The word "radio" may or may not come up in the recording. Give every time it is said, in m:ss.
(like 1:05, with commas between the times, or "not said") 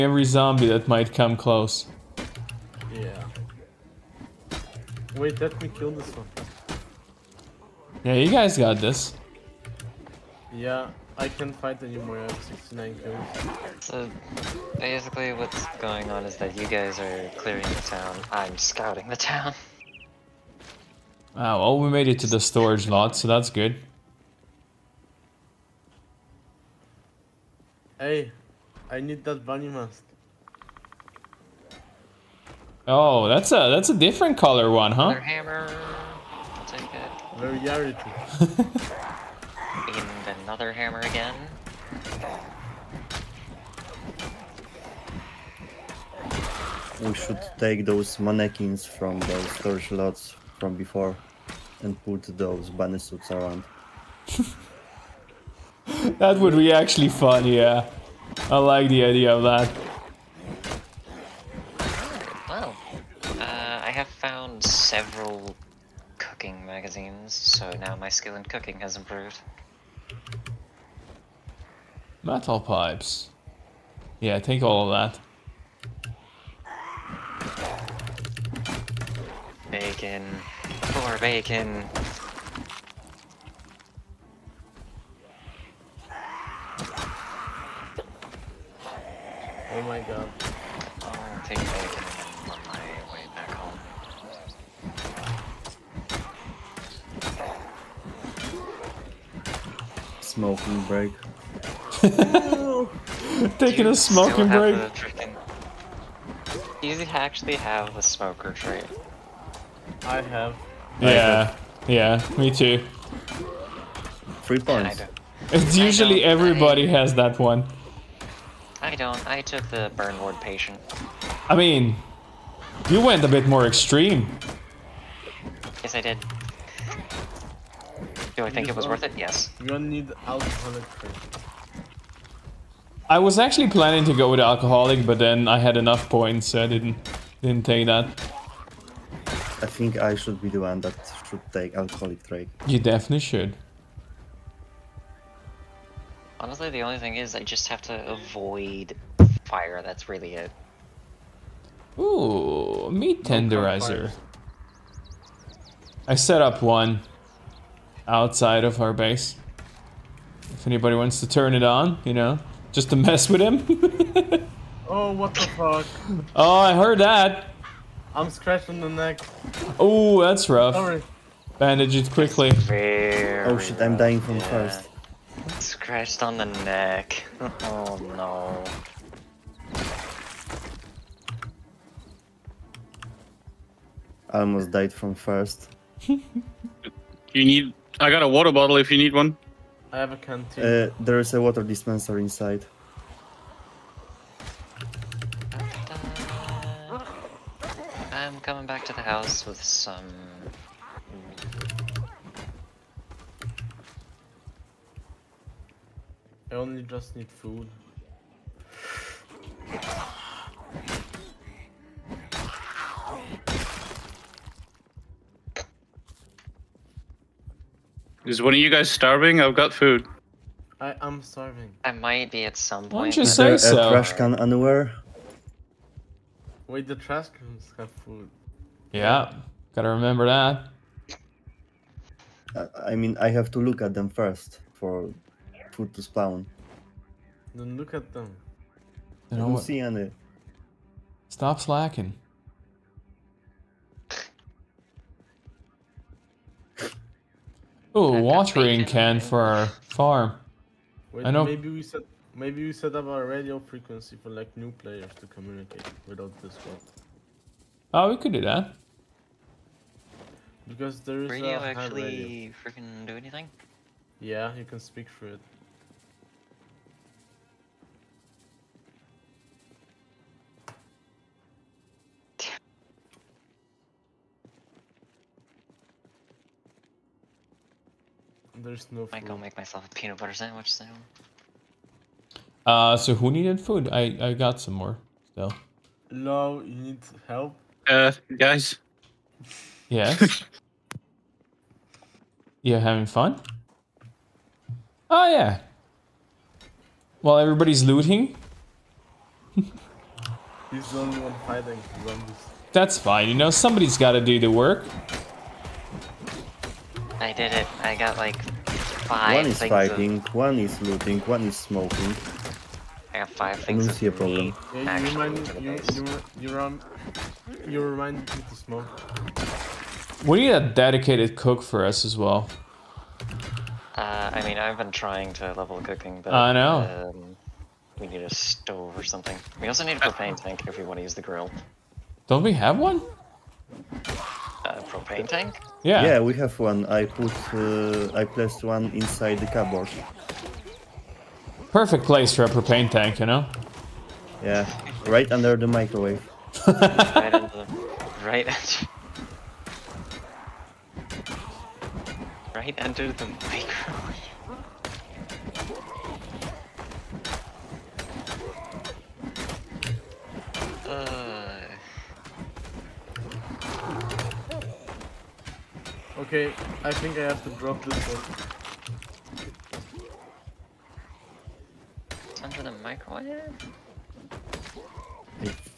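4:13, 4:21.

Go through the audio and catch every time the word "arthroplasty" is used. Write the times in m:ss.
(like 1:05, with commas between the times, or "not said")
not said.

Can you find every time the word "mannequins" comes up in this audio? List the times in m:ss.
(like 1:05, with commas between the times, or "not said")
0:48.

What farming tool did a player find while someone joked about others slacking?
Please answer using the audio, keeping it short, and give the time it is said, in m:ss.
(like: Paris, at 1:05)
Watering can, at 4:08.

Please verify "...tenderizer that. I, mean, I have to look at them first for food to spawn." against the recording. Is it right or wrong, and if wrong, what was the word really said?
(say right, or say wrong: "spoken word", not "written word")
wrong: "remember", not "tenderizer".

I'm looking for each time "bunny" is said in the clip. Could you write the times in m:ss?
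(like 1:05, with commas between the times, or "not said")
0:29, 0:52.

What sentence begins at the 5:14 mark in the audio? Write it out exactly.
Yeah, you, remind, you, you, you, run, you remind me to smoke.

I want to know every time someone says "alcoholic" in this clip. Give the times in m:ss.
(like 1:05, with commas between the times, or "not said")
2:10, 2:14, 2:21.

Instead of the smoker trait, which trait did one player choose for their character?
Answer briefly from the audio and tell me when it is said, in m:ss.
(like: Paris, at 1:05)
Burn ward patient, at 1:59.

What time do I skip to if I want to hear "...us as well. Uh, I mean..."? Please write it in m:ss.
5:21.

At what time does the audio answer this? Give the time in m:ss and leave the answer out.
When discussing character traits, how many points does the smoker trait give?
1:54.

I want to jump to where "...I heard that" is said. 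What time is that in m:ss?
2:46.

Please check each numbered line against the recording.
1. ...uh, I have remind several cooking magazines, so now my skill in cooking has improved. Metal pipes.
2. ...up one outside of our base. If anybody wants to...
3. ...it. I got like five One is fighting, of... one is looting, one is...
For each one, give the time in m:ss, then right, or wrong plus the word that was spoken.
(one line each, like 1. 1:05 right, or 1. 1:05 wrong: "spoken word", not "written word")
1. 1:03 wrong: "found", not "remind"
2. 2:36 right
3. 5:07 right.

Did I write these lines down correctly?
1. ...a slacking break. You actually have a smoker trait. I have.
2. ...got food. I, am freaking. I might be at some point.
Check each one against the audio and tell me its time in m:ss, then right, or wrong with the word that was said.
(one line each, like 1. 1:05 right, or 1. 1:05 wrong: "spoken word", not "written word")
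1. 1:43 wrong: "smoking", not "slacking"
2. 3:39 wrong: "starving", not "freaking".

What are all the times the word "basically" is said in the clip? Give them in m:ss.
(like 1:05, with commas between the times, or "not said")
0:14.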